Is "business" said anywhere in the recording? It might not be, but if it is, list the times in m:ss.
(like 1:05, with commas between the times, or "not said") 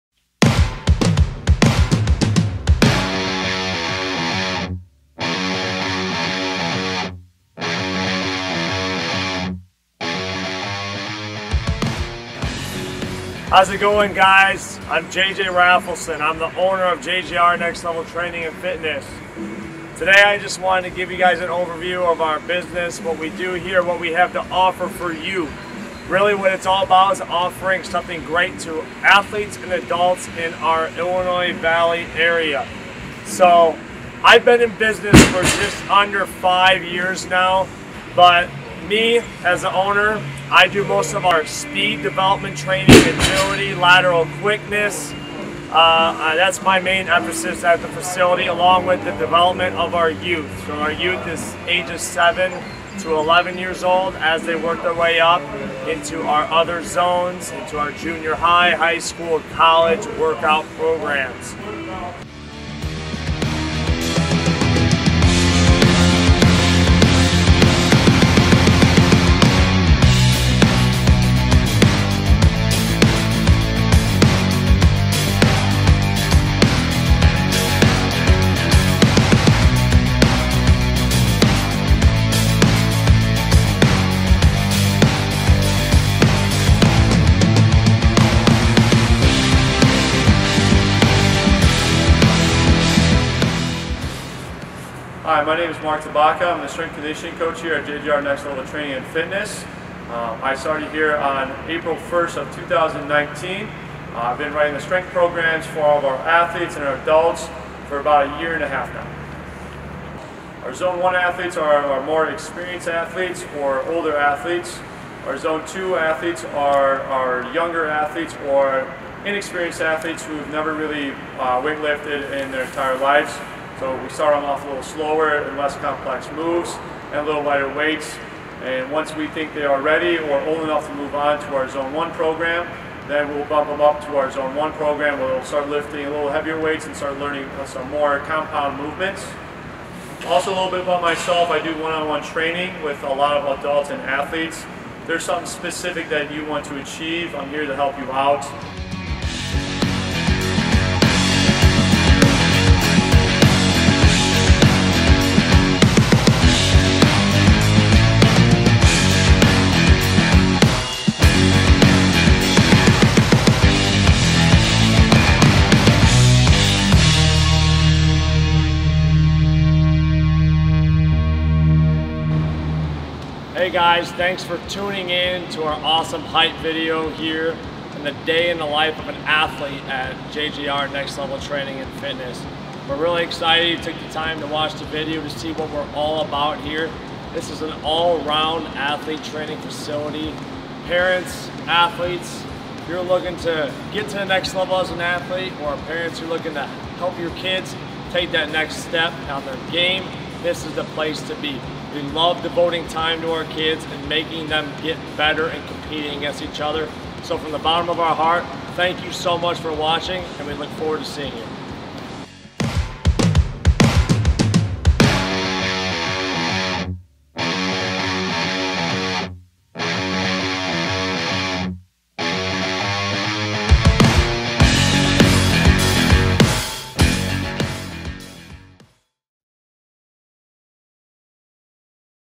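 0:22, 0:34.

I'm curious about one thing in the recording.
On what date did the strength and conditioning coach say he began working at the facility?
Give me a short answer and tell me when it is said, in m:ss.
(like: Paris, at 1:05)
April 1, 2019, at 1:41.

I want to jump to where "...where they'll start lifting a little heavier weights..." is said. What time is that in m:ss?
2:15.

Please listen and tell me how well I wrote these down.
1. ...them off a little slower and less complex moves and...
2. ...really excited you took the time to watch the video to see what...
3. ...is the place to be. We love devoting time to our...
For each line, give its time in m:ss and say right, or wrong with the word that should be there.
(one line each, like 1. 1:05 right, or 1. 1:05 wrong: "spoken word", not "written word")
1. 2:04 right
2. 3:02 right
3. 3:20 right.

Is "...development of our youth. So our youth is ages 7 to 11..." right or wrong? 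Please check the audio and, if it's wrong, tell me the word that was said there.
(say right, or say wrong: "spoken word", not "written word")
right.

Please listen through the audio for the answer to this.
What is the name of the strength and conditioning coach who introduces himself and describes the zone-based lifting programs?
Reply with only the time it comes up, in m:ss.
1:35.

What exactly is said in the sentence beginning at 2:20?
Also a little bit about myself, I do one-on-one -on -one training with a lot of adults and athletes.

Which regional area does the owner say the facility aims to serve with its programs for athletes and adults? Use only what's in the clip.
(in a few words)
Illinois Valley.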